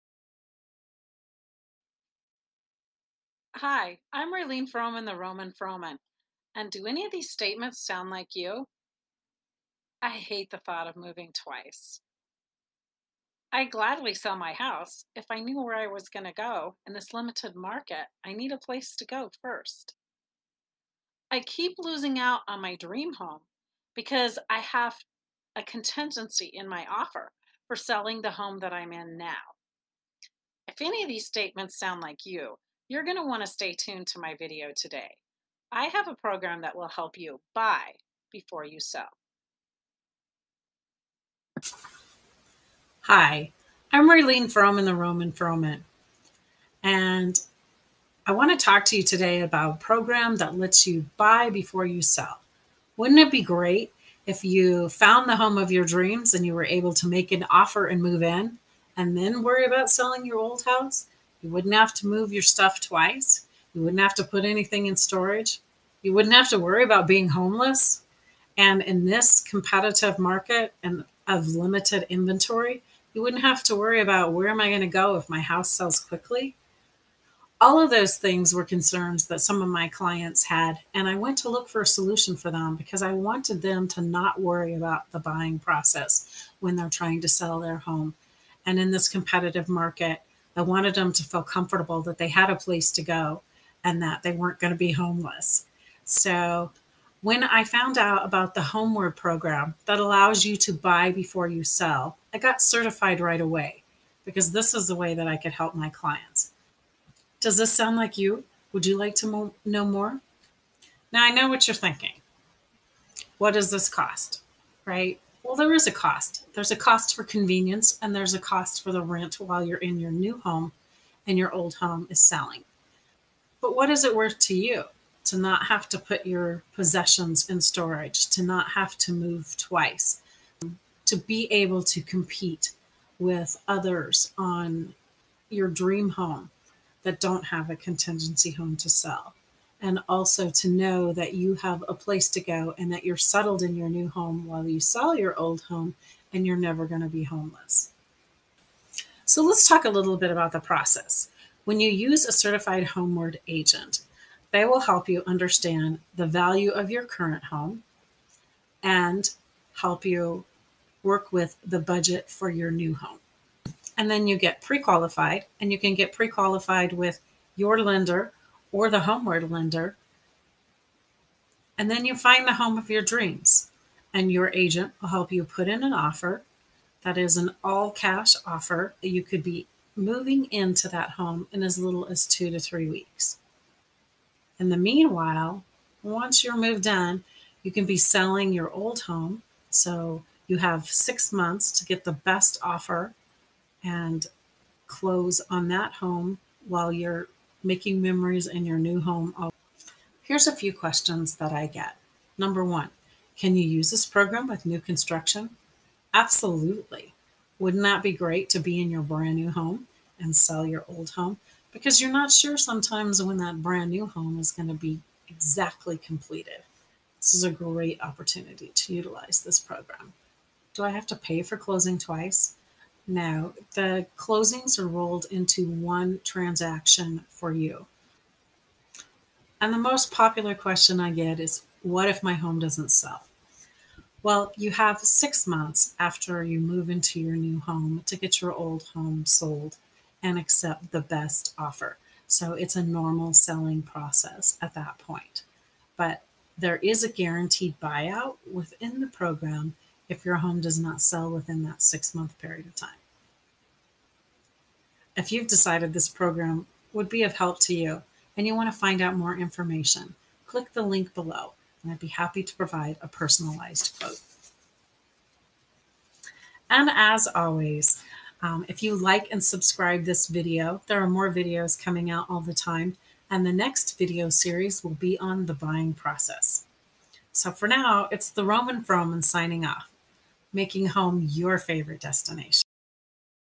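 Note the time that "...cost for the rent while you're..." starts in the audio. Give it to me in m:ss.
1:58.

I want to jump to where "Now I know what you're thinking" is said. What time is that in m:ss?
1:51.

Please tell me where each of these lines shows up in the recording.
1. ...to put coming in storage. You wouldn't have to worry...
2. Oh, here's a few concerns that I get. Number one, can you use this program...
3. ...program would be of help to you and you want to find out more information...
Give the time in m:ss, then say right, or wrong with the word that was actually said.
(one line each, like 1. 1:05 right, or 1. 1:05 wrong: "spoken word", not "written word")
1. 1:04 wrong: "anything", not "coming"
2. 3:19 wrong: "questions", not "concerns"
3. 4:16 right.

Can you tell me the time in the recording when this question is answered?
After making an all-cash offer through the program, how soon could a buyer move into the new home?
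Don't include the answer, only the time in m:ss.
3:02.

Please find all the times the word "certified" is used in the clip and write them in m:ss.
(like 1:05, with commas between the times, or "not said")
1:42, 2:32.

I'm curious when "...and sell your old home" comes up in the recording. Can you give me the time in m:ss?
3:30.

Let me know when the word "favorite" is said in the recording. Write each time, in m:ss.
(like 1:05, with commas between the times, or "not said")
4:41.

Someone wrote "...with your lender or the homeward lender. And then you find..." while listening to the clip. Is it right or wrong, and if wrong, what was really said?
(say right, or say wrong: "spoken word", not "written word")
right.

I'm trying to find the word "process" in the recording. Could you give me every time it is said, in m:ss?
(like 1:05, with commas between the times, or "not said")
1:25, 2:30, 4:03, 4:35.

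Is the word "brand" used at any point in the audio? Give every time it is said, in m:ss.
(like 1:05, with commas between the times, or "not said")
3:29, 3:33.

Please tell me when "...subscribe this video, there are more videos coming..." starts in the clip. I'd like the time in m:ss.
4:29.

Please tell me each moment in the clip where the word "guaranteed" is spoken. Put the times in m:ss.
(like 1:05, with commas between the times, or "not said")
4:07.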